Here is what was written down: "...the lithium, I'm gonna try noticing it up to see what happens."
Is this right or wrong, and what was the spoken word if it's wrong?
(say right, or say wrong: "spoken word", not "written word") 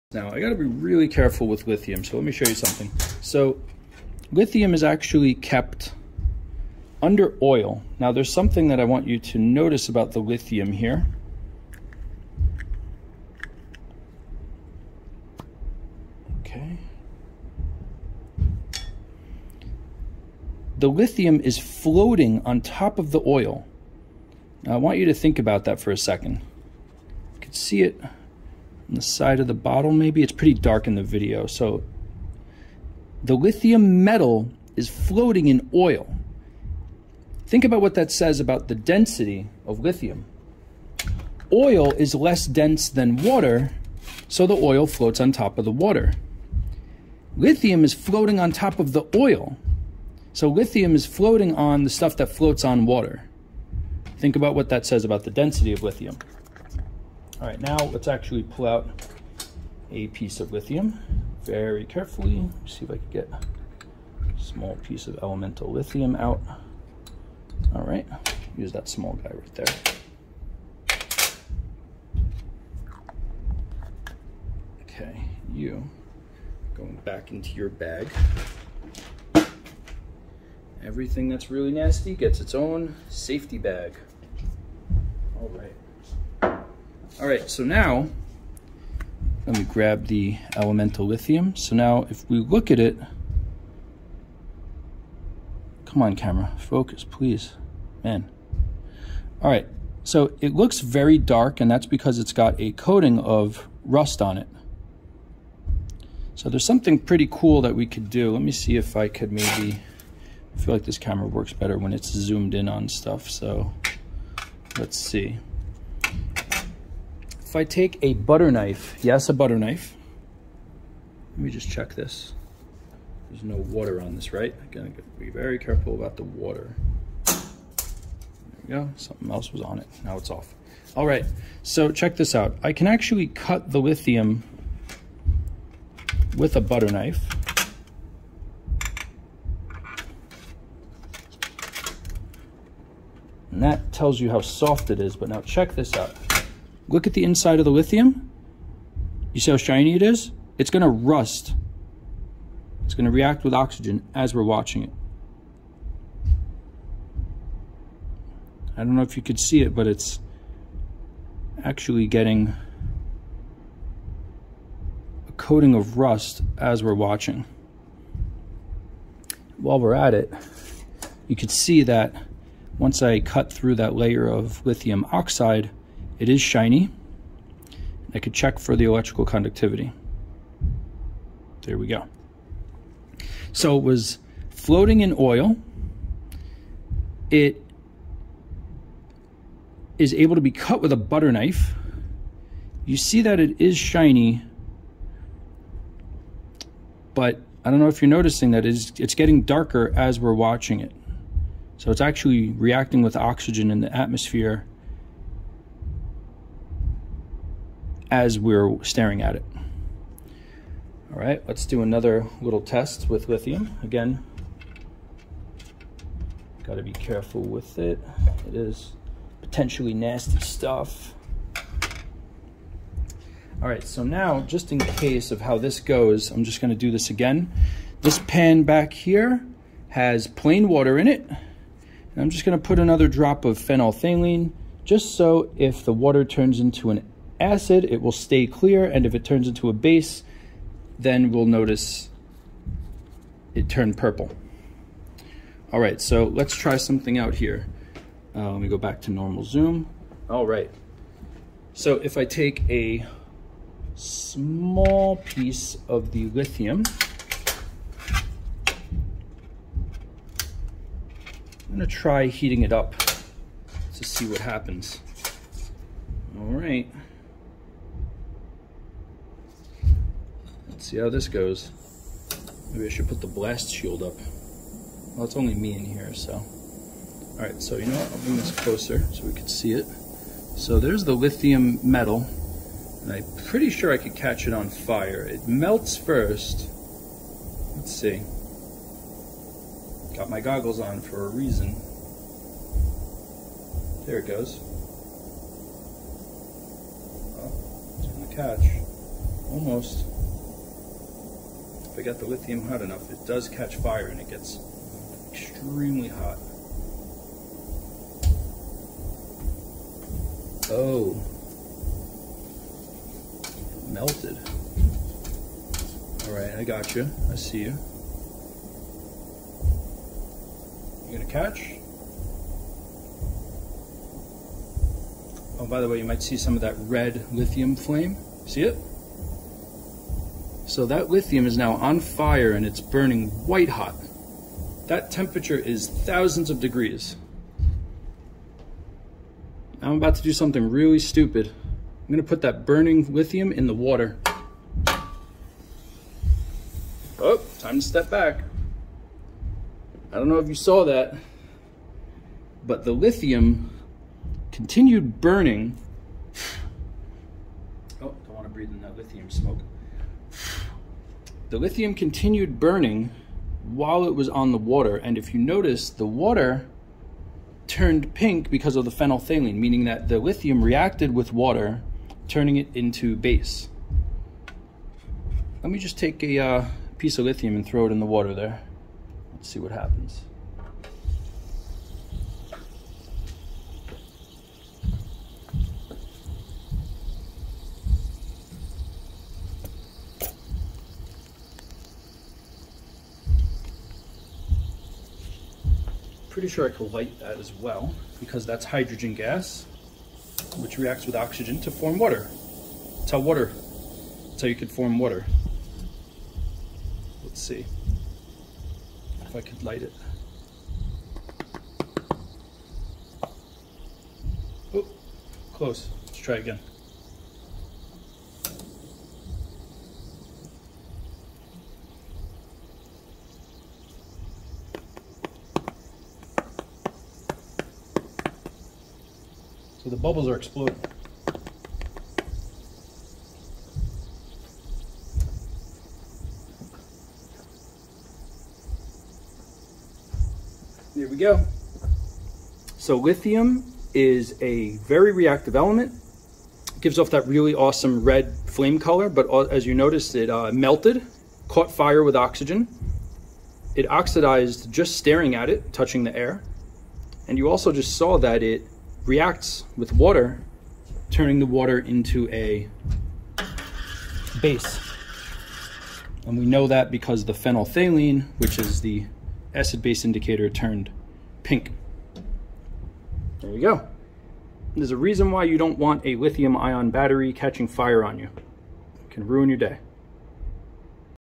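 wrong: "heating", not "noticing".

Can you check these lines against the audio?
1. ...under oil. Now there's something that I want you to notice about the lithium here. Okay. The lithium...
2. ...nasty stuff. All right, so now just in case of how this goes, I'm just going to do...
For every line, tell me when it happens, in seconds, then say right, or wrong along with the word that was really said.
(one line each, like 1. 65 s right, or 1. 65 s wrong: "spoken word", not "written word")
1. 7 s right
2. 219 s right.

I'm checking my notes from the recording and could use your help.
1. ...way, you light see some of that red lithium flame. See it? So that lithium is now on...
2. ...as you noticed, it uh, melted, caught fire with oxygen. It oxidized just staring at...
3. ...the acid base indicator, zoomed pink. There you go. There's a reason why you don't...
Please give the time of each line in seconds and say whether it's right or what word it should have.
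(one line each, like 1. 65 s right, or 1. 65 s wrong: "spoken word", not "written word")
1. 325 s wrong: "might", not "light"
2. 449 s right
3. 468 s wrong: "turned", not "zoomed".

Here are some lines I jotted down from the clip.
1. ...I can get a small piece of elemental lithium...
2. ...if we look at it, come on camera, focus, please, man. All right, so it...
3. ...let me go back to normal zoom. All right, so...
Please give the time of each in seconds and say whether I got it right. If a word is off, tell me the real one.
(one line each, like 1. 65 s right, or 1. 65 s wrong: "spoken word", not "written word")
1. 62 s right
2. 92 s right
3. 248 s right.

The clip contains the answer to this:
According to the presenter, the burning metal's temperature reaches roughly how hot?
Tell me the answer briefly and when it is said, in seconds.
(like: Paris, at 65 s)
thousands of degrees, at 335 s.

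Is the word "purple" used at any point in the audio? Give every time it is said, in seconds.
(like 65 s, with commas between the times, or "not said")
243 s.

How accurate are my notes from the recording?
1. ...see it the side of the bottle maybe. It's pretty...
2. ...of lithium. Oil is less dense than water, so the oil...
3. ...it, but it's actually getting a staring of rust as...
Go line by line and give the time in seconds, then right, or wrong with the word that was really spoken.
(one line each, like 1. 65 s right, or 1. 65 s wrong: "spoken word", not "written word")
1. 27 s right
2. 39 s right
3. 159 s wrong: "coating", not "staring".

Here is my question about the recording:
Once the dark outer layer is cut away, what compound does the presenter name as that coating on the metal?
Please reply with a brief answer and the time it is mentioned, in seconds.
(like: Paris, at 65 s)
lithium oxide, at 174 s.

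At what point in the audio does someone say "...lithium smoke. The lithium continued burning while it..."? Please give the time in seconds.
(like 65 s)
358 s.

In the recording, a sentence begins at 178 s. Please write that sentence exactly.
I could check for the electrical conductivity.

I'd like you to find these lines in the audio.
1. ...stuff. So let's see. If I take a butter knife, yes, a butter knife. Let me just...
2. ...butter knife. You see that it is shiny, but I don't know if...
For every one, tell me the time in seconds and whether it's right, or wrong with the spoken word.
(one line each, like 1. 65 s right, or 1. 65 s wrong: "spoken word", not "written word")
1. 112 s right
2. 190 s right.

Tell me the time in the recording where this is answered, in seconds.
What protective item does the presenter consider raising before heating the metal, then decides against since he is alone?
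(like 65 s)
273 s.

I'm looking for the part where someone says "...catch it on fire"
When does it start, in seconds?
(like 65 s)
284 s.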